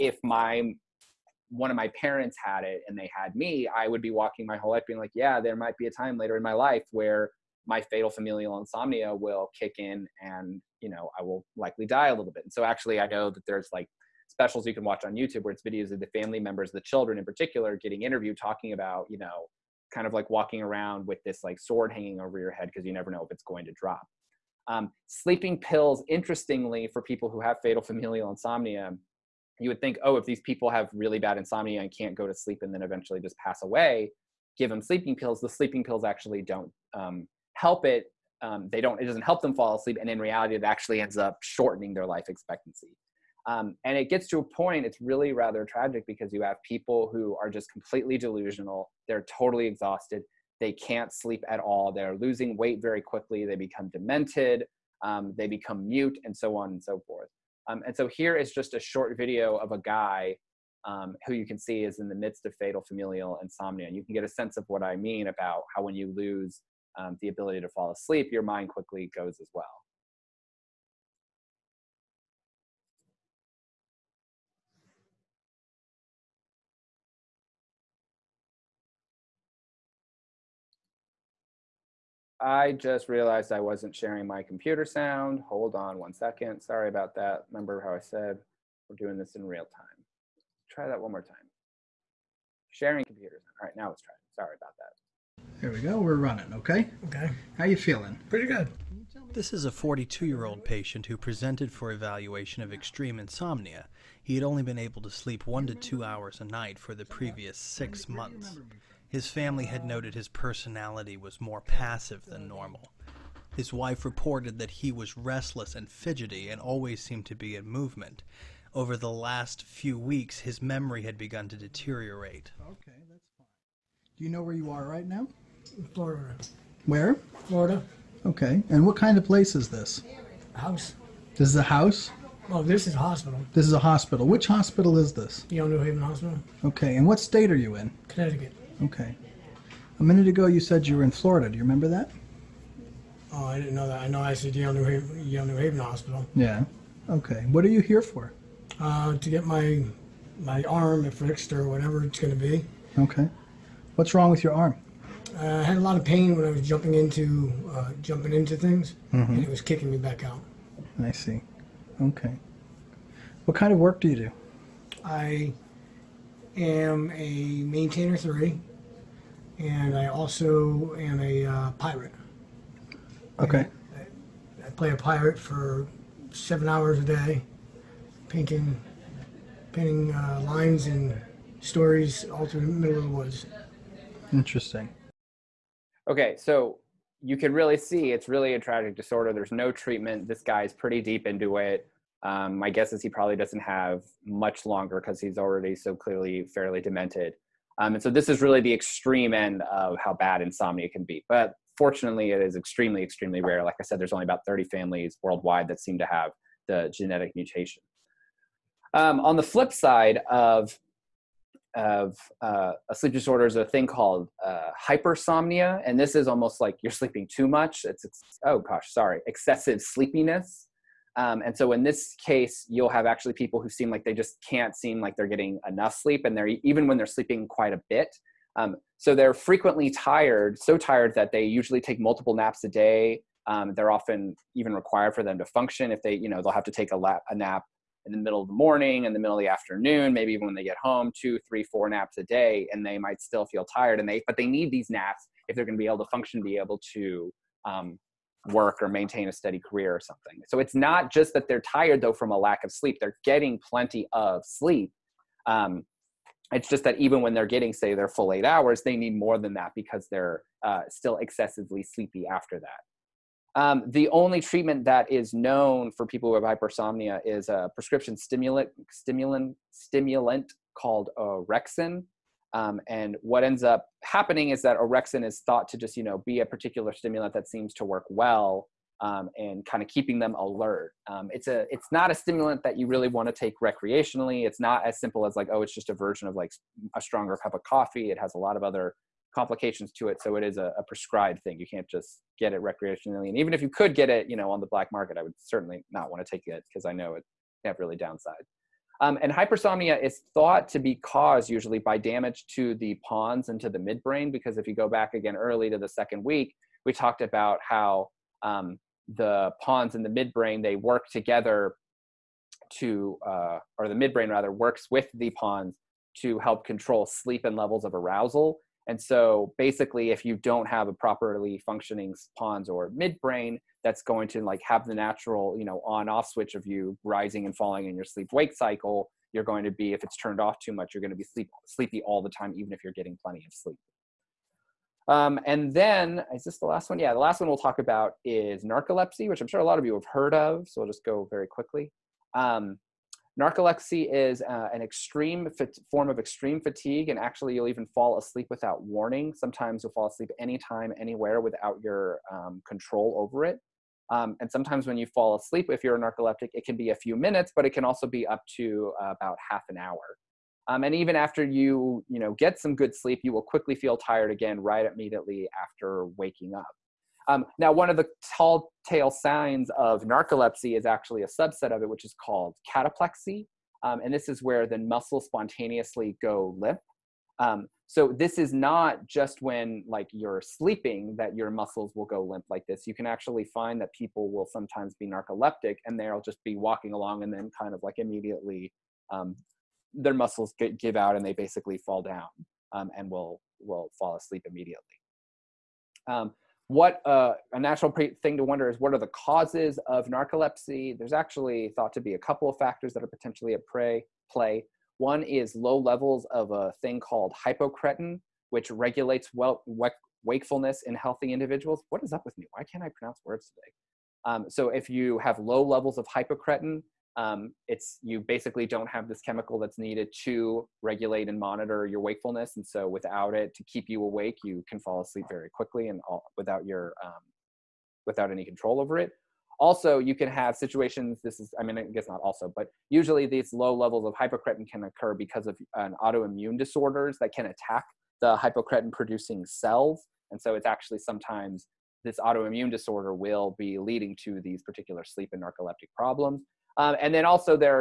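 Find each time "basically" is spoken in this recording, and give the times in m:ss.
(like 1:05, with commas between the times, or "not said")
5:19, 6:31, 6:58.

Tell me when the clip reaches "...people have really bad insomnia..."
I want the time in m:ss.
0:30.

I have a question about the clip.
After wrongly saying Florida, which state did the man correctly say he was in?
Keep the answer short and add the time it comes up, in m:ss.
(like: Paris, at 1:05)
Connecticut, at 2:18.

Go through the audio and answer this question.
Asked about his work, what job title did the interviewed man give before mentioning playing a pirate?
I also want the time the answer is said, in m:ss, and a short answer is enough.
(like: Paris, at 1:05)
Maintainer three, at 2:47.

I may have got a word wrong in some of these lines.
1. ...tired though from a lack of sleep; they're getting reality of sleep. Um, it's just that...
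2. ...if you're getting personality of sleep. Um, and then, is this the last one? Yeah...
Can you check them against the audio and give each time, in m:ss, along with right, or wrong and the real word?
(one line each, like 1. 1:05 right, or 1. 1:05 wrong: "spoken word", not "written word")
1. 4:11 wrong: "plenty", not "reality"
2. 5:32 wrong: "plenty", not "personality".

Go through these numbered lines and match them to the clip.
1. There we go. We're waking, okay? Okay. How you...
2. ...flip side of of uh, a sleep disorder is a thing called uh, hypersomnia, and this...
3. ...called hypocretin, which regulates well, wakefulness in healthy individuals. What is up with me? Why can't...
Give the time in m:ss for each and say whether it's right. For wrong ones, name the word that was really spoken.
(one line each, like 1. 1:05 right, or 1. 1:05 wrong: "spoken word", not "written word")
1. 1:35 wrong: "running", not "waking"
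2. 3:29 right
3. 6:47 right.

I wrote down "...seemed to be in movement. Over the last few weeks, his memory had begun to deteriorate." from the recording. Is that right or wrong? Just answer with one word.
right.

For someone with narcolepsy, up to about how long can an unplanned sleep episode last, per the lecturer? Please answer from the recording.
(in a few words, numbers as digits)
Half an hour.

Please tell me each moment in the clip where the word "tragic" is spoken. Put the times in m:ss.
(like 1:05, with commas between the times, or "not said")
0:45, 3:08.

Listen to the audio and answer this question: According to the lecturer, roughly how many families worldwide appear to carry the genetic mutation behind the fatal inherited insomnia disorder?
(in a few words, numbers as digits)
30.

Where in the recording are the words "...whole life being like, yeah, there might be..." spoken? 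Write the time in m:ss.
0:04.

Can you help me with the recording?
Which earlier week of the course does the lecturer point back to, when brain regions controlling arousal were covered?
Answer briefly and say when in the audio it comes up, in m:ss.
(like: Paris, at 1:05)
Second week, at 5:05.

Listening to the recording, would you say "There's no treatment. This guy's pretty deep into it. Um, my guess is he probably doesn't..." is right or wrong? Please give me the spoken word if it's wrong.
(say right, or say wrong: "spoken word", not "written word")
right.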